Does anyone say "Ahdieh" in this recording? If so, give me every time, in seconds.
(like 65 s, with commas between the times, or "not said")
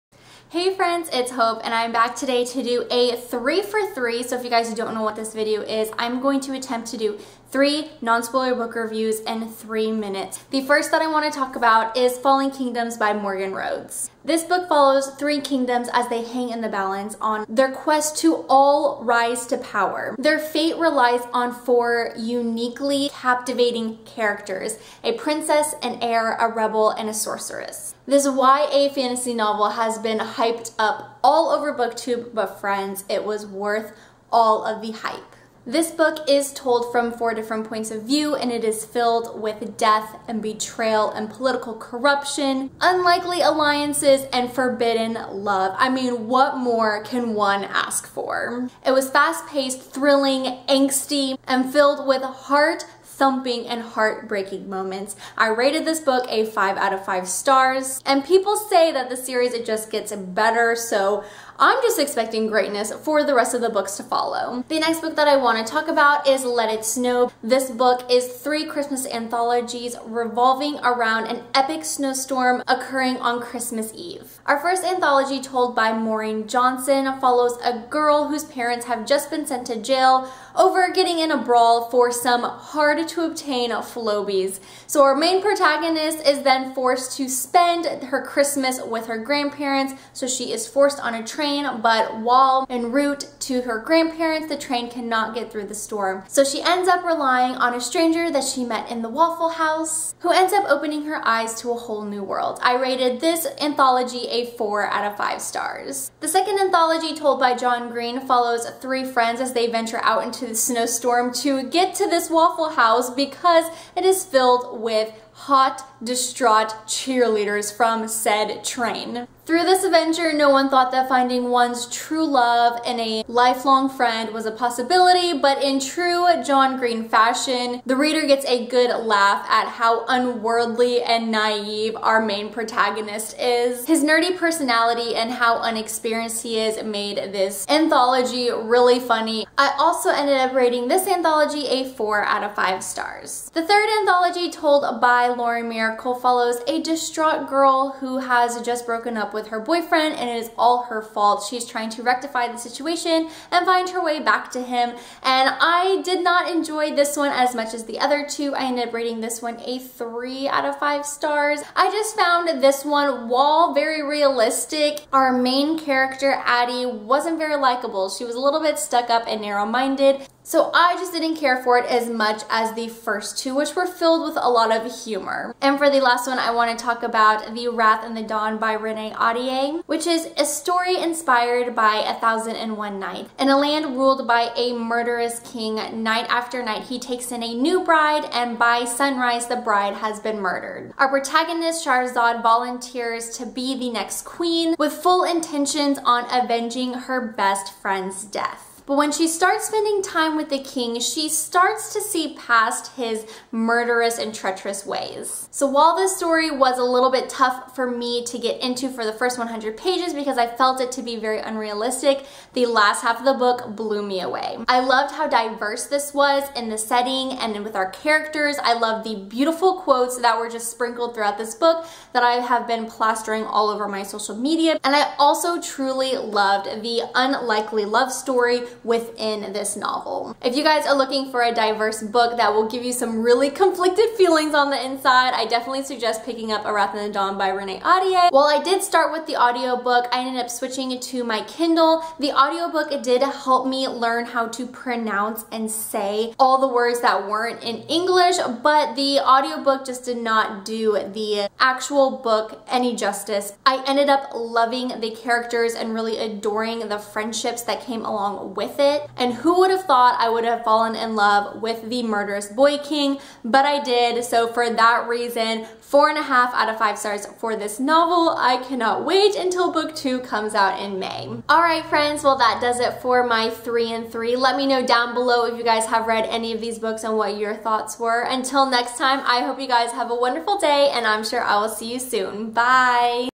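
179 s, 237 s.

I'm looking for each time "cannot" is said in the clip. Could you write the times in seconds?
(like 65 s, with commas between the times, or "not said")
94 s, 268 s.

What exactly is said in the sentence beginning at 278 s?
Until next time, I hope you guys have a wonderful day and I'm sure I will see you soon.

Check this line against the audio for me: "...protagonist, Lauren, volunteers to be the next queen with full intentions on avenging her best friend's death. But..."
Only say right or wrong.
wrong.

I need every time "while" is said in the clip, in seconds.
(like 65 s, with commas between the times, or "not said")
92 s, 163 s, 205 s, 238 s.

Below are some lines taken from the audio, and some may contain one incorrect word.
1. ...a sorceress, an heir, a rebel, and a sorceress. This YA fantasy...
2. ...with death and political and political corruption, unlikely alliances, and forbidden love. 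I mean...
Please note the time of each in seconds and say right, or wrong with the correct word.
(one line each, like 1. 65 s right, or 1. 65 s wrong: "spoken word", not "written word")
1. 25 s wrong: "princess", not "sorceress"
2. 39 s wrong: "betrayal", not "political".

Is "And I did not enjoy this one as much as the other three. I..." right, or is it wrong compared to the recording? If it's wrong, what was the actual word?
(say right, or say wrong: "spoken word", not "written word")
wrong: "two", not "three".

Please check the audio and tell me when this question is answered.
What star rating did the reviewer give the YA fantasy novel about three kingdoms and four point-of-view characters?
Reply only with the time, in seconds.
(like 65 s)
56 s.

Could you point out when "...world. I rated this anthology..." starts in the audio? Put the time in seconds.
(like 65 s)
102 s.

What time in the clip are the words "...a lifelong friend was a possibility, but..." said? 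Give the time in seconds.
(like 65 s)
123 s.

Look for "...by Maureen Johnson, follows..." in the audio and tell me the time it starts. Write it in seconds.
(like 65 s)
75 s.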